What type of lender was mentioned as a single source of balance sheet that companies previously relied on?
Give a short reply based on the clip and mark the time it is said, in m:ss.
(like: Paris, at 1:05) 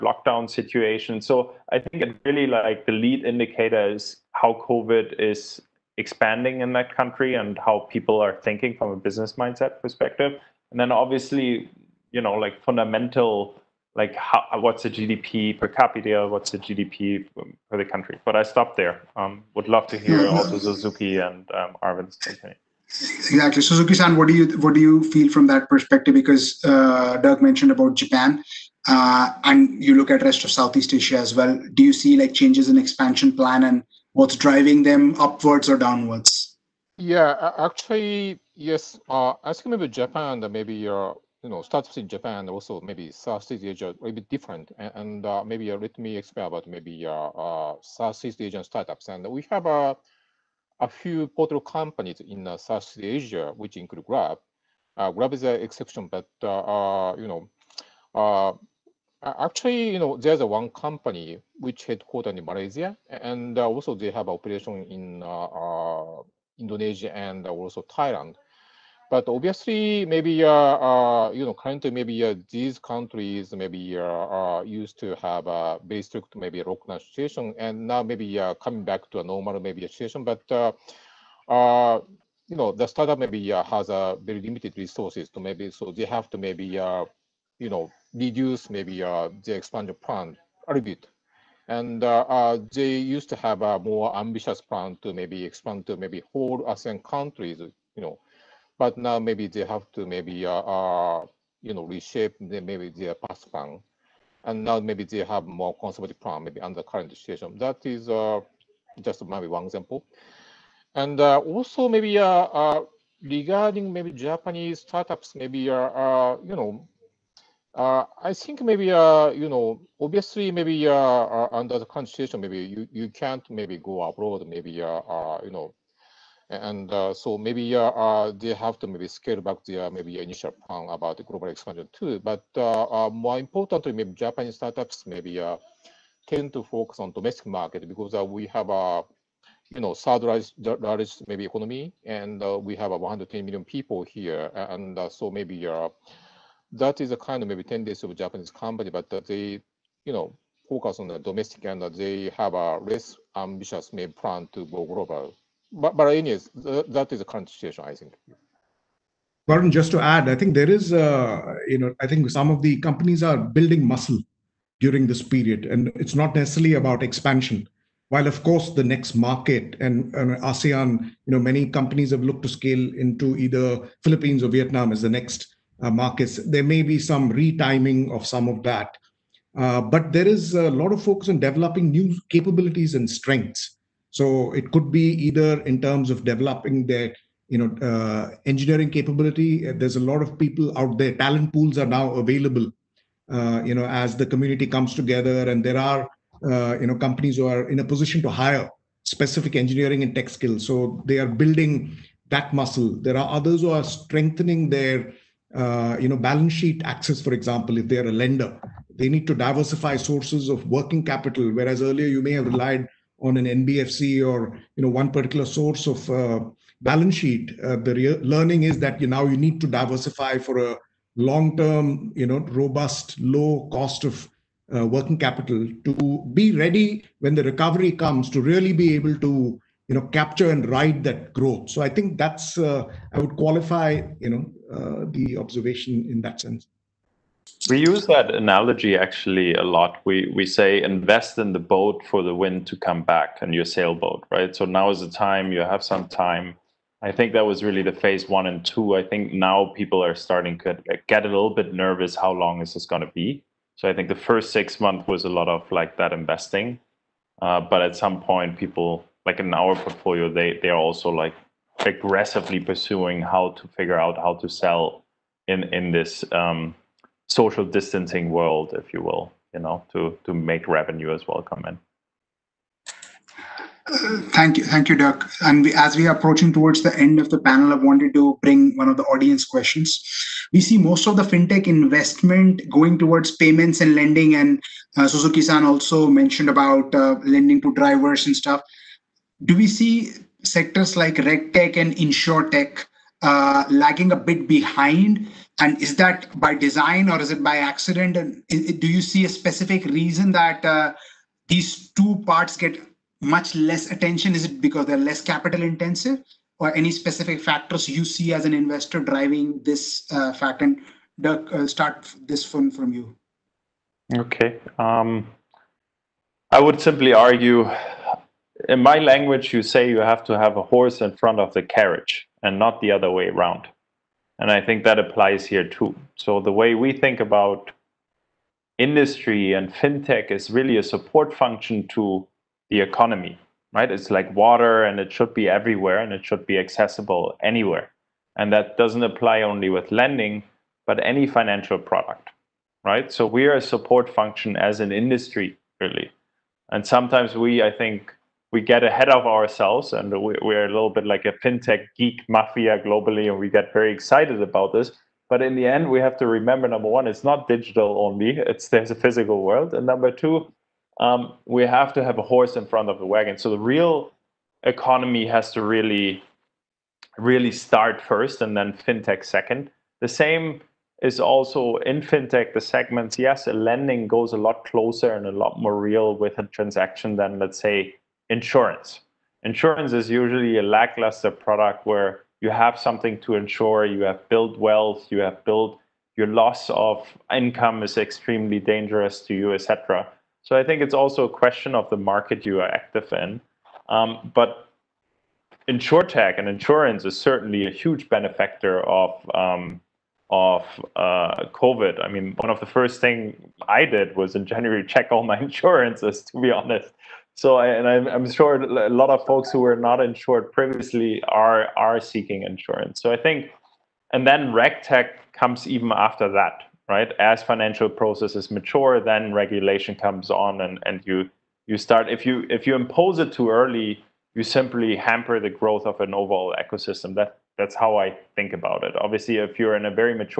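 NBFC, at 3:33.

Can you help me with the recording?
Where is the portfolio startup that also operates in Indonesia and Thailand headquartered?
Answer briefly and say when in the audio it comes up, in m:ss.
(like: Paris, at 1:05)
Malaysia, at 1:02.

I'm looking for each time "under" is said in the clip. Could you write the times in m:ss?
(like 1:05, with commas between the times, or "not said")
1:46, 2:01.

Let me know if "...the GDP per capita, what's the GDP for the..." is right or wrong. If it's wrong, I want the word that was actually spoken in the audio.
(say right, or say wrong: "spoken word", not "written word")
right.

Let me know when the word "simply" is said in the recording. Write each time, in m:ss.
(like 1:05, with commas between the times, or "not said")
5:16, 7:04.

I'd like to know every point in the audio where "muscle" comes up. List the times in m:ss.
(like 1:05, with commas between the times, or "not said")
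2:43, 3:22.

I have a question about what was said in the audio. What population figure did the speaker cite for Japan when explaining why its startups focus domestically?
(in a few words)
110 million.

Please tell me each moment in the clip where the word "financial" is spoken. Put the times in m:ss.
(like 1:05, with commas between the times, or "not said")
5:41, 6:57.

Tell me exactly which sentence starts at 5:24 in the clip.
And I think that applies here too.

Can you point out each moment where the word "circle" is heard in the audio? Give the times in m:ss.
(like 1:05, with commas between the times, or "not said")
not said.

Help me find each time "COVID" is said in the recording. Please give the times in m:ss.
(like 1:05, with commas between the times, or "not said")
0:04, 6:41.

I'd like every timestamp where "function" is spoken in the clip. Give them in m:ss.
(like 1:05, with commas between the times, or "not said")
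5:31, 5:44.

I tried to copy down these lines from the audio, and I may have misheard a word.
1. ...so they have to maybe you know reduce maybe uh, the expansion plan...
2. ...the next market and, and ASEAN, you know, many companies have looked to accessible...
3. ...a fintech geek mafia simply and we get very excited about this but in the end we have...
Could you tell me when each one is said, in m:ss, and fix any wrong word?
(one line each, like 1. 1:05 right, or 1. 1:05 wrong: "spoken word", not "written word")
1. 1:25 right
2. 2:48 wrong: "scale", not "accessible"
3. 5:51 wrong: "globally", not "simply".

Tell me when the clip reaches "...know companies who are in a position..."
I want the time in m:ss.
3:16.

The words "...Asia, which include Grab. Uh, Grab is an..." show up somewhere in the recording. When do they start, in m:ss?
0:53.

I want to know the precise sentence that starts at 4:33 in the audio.
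Uh, thank you, thank you, Dirk.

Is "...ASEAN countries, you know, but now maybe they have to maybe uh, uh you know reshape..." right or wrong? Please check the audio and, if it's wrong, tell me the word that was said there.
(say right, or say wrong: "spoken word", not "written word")
right.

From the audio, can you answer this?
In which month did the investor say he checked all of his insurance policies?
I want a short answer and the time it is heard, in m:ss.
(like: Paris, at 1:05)
January, at 6:44.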